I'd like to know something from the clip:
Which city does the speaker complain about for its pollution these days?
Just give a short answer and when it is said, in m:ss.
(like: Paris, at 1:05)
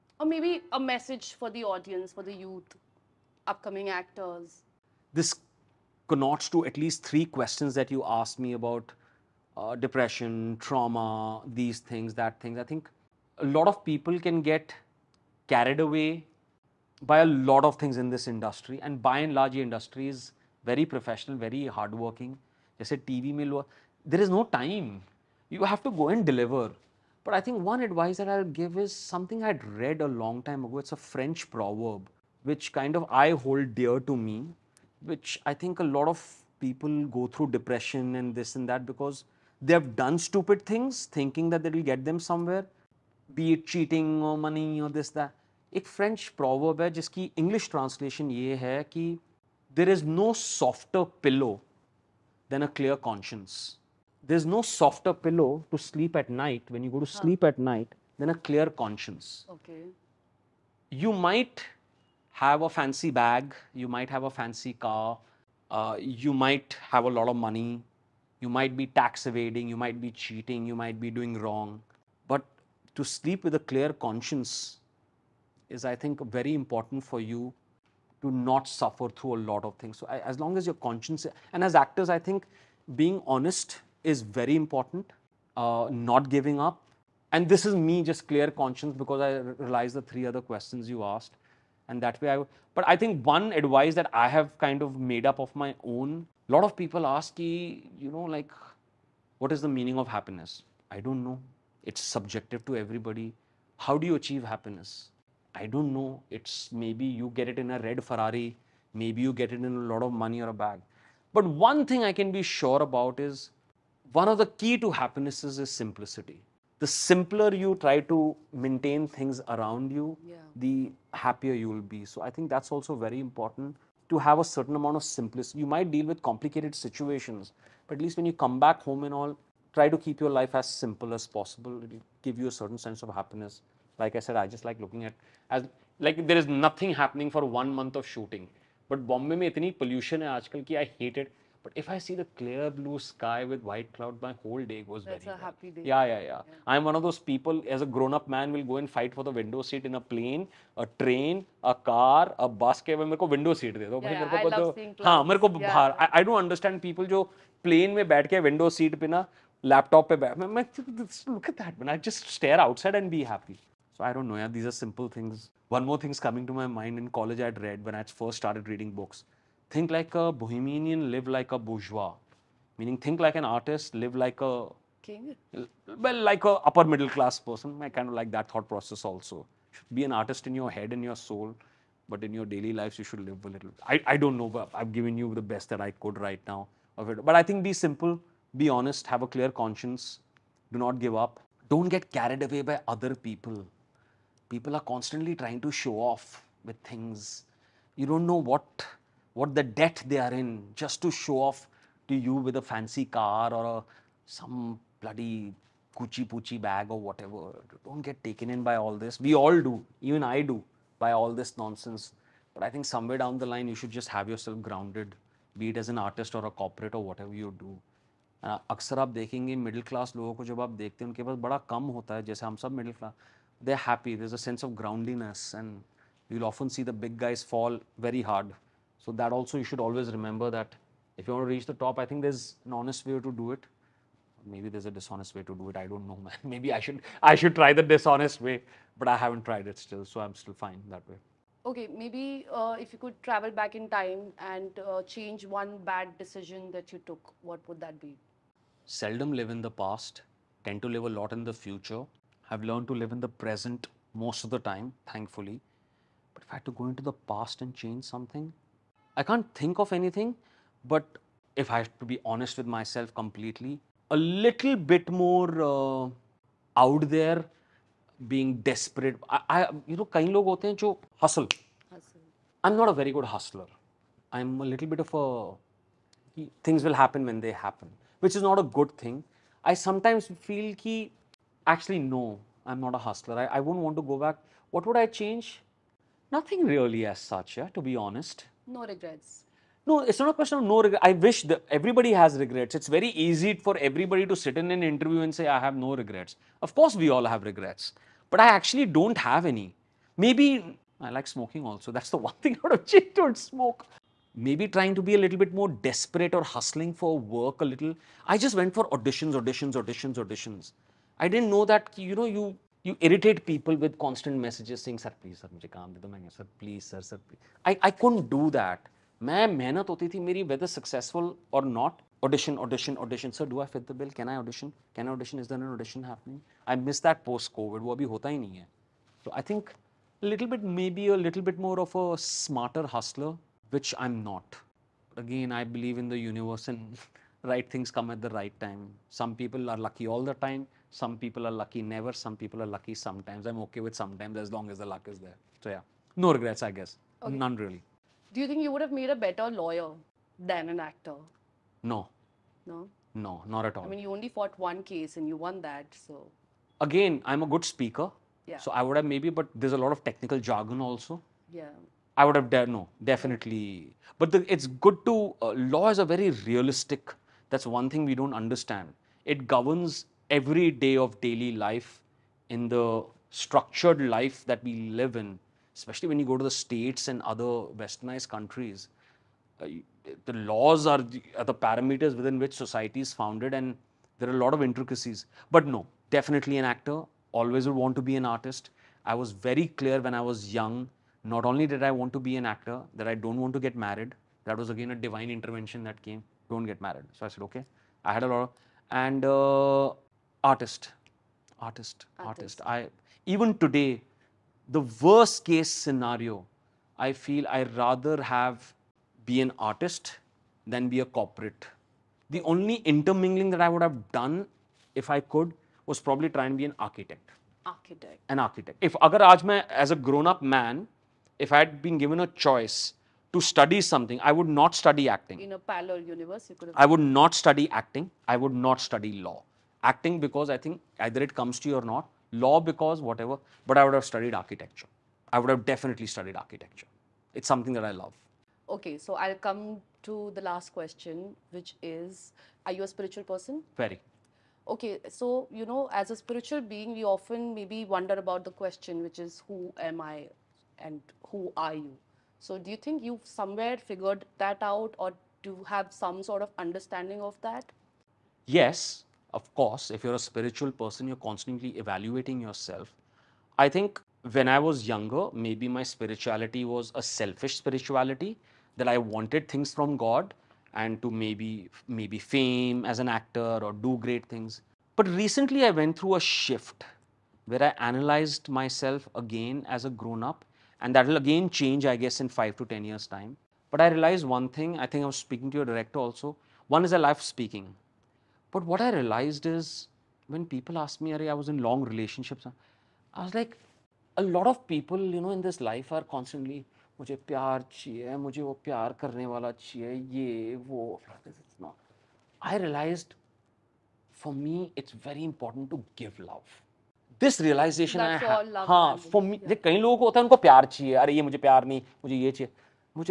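Bombay, at 2:19.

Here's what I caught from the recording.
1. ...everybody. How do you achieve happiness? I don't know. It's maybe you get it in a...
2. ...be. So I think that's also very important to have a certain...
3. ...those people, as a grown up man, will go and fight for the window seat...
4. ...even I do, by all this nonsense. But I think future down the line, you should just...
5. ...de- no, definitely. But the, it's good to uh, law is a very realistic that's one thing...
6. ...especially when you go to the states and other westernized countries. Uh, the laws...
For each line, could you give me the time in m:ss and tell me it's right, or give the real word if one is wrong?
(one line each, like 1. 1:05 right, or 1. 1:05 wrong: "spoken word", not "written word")
1. 1:42 right
2. 2:01 right
3. 2:27 right
4. 3:30 wrong: "somewhere", not "future"
5. 6:02 right
6. 6:15 right.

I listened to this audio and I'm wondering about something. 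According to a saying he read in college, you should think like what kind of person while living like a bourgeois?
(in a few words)
A bohemian.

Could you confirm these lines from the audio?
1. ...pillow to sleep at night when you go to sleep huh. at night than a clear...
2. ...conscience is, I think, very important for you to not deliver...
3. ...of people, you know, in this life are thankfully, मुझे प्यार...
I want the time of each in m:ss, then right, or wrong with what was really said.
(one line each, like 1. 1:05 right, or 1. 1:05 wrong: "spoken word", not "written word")
1. 0:55 right
2. 1:13 wrong: "suffer", not "deliver"
3. 8:14 wrong: "constantly", not "thankfully".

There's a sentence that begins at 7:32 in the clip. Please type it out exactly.
So do you think you've somewhere figured that out or do you have some sort of understanding of that?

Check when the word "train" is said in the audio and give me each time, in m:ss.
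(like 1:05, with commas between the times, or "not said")
2:31.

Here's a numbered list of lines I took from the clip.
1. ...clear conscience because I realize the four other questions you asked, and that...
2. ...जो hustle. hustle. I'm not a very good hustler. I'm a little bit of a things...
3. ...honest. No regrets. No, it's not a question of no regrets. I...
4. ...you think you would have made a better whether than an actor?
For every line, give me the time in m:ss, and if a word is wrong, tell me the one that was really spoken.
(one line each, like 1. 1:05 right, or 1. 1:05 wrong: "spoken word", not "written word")
1. 1:28 wrong: "three", not "four"
2. 4:30 right
3. 4:47 right
4. 5:48 wrong: "lawyer", not "whether".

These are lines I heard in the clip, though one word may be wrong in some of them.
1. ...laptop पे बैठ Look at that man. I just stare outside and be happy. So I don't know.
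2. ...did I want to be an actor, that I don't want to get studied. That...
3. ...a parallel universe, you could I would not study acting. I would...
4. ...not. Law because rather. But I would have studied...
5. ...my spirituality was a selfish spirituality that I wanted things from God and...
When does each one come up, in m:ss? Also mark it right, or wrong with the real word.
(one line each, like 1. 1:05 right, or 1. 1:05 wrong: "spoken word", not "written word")
1. 2:39 right
2. 6:31 wrong: "married", not "studied"
3. 7:05 right
4. 7:11 wrong: "whatever", not "rather"
5. 7:45 right.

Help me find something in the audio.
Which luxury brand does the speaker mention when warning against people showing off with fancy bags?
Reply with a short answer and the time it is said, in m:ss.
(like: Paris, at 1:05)
Gucci, at 3:25.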